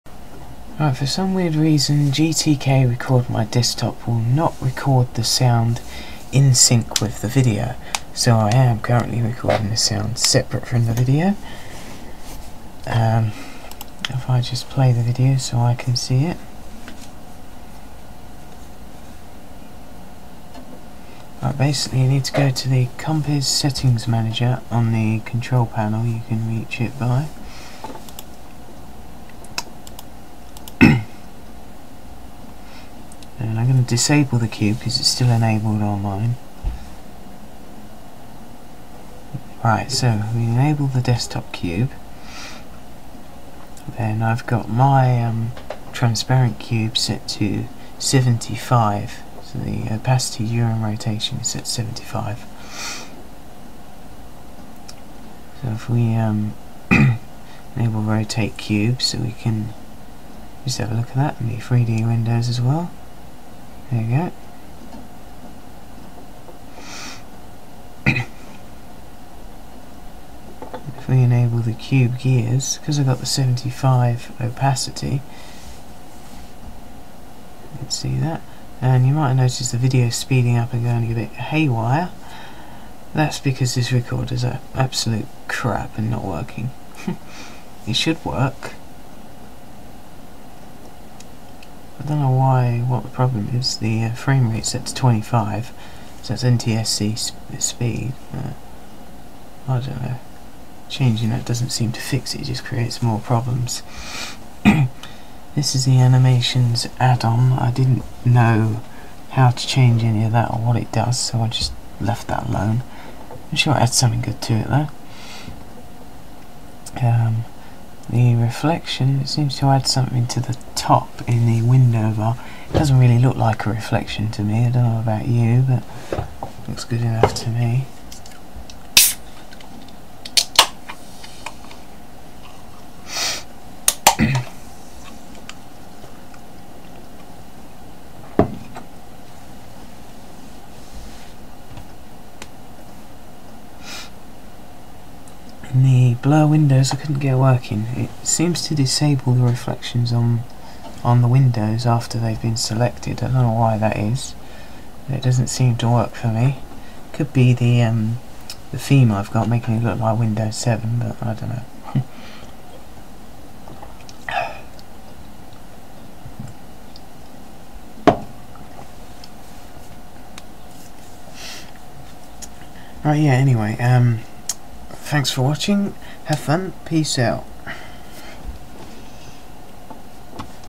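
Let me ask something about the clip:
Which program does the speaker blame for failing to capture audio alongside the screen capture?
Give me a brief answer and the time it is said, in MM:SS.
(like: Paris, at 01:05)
GTK Record My Desktop, at 00:02.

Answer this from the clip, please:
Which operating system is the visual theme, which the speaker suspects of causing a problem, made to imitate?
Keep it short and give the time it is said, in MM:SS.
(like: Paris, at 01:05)
Windows 7, at 02:40.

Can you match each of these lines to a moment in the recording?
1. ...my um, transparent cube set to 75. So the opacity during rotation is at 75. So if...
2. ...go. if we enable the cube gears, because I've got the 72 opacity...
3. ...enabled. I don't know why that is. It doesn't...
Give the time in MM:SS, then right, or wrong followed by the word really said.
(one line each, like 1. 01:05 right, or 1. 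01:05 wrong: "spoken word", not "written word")
1. 00:44 right
2. 01:04 wrong: "75", not "72"
3. 02:32 wrong: "selected", not "enabled".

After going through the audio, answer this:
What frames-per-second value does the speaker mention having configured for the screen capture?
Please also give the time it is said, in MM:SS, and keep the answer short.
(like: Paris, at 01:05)
25, at 01:34.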